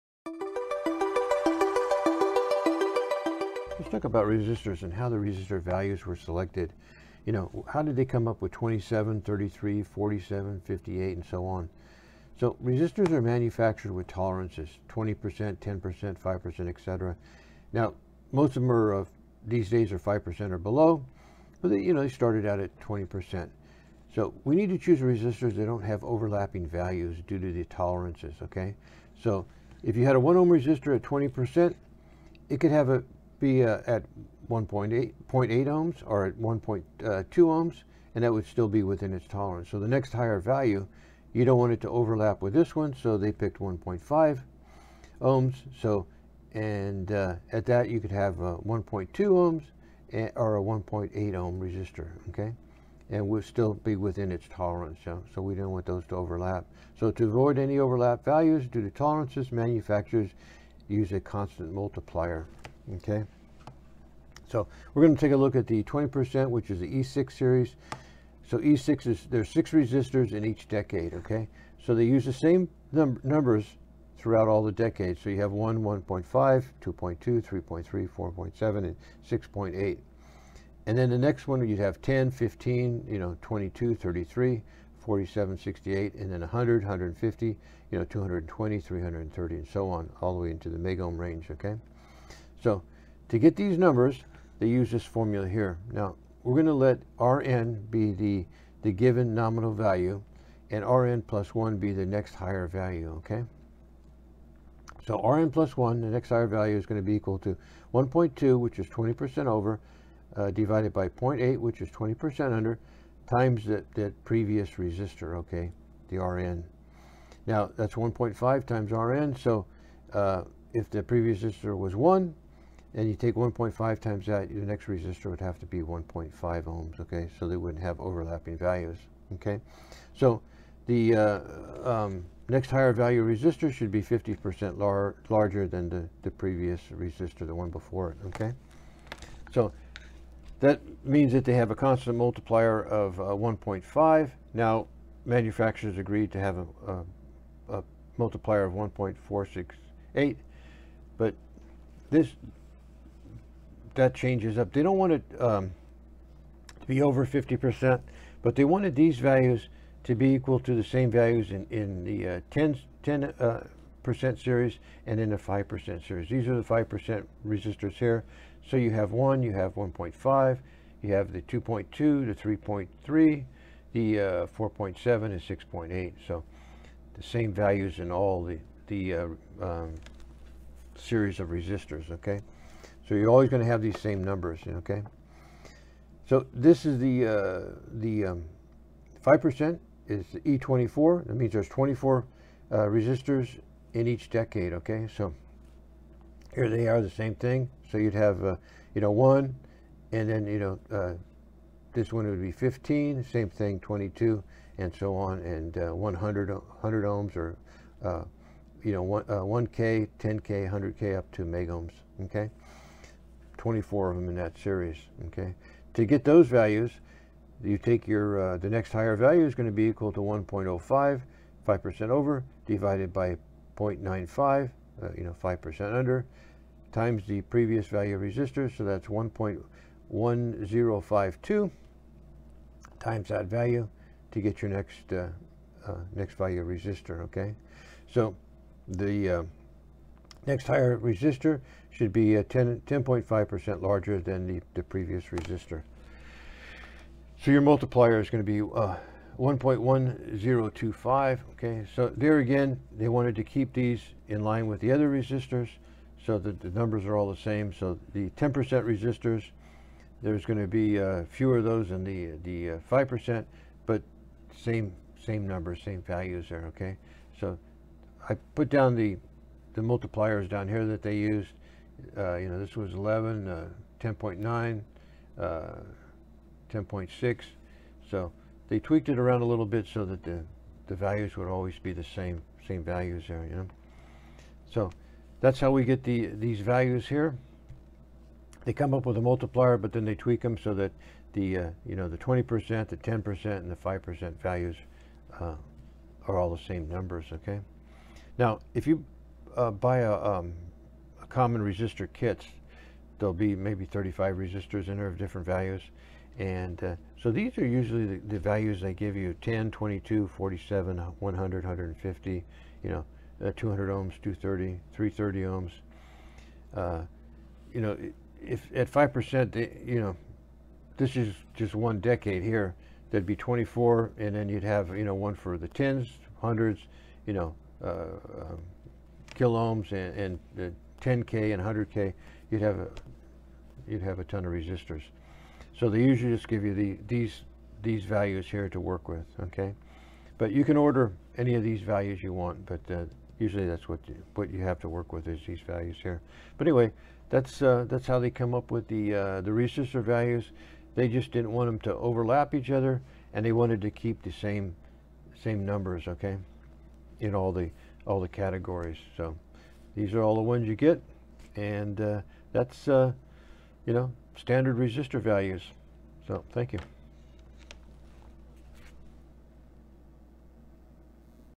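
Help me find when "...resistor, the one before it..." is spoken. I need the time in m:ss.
2:16.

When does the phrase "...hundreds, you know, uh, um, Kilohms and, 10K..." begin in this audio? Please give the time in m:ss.
5:26.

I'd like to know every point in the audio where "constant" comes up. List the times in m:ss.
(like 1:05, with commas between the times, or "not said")
1:01, 2:21.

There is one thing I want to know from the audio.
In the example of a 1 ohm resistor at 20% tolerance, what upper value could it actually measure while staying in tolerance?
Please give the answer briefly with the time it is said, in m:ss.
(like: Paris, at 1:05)
1.8 ohms, at 0:34.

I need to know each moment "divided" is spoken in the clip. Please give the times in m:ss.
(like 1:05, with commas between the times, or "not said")
1:50, 3:42.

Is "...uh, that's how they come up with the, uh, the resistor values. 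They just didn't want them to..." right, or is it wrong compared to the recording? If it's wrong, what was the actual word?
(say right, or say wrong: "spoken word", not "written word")
right.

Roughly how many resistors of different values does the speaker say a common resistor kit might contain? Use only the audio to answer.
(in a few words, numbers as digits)
35.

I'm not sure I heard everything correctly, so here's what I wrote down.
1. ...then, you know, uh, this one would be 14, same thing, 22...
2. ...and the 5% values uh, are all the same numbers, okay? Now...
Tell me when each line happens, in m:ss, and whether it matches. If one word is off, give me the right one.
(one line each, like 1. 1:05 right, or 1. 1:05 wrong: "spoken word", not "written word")
1. 3:20 wrong: "15", not "14"
2. 4:53 right.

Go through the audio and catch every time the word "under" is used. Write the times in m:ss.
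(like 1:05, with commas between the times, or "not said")
1:52, 3:45.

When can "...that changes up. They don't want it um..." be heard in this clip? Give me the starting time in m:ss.
2:33.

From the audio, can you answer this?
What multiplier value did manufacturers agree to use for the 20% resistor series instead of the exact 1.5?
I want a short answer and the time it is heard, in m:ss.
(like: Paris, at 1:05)
1.468, at 2:28.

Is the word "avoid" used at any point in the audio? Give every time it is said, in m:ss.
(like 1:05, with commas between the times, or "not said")
0:57.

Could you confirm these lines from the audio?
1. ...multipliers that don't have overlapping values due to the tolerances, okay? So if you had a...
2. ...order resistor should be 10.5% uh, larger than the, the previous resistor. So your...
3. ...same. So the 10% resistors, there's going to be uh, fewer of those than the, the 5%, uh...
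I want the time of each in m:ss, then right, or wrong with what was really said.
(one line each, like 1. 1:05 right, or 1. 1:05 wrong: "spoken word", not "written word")
1. 0:24 wrong: "resistors", not "multipliers"
2. 4:00 wrong: "higher", not "order"
3. 4:17 right.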